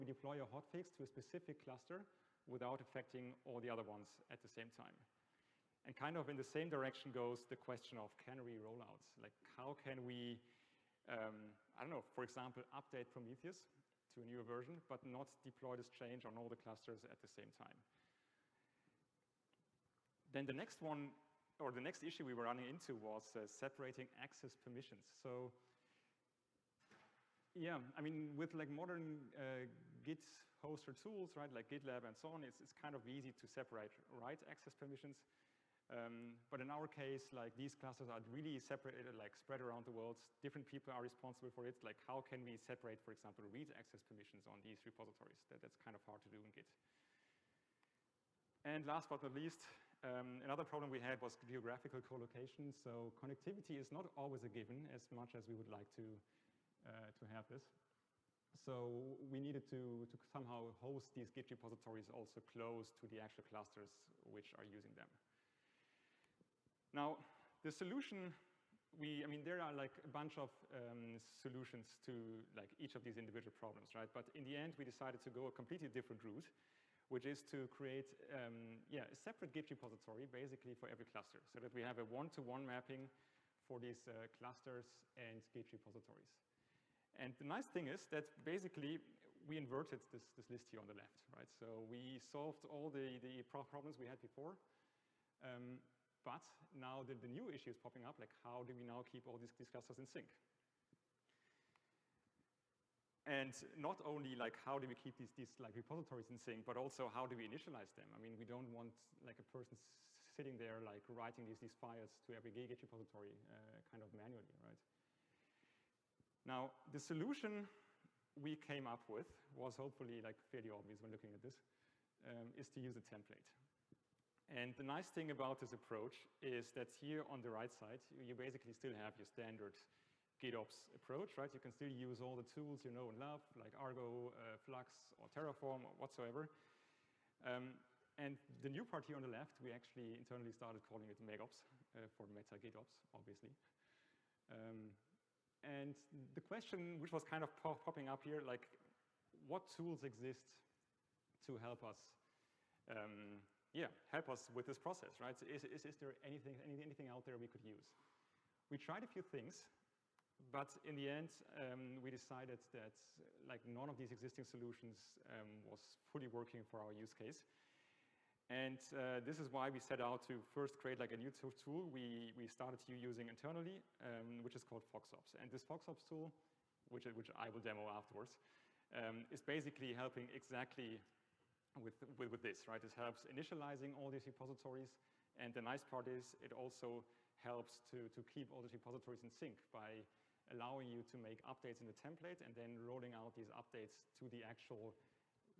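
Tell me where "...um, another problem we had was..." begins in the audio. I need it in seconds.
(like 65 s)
50 s.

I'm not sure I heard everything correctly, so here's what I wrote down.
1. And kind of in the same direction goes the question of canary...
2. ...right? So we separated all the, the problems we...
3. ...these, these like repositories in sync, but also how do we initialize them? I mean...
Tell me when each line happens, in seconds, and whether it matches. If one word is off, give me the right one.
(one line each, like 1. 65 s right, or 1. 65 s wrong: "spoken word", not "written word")
1. 5 s right
2. 91 s wrong: "solved", not "separated"
3. 105 s right.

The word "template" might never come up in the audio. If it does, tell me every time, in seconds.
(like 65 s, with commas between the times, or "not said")
123 s, 191 s.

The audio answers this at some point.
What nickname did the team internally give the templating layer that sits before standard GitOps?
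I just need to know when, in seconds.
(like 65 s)
141 s.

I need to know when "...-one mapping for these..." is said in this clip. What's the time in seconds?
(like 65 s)
82 s.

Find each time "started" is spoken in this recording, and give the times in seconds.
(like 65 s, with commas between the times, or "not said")
140 s, 172 s.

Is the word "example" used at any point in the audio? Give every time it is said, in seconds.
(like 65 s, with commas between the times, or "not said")
12 s, 43 s.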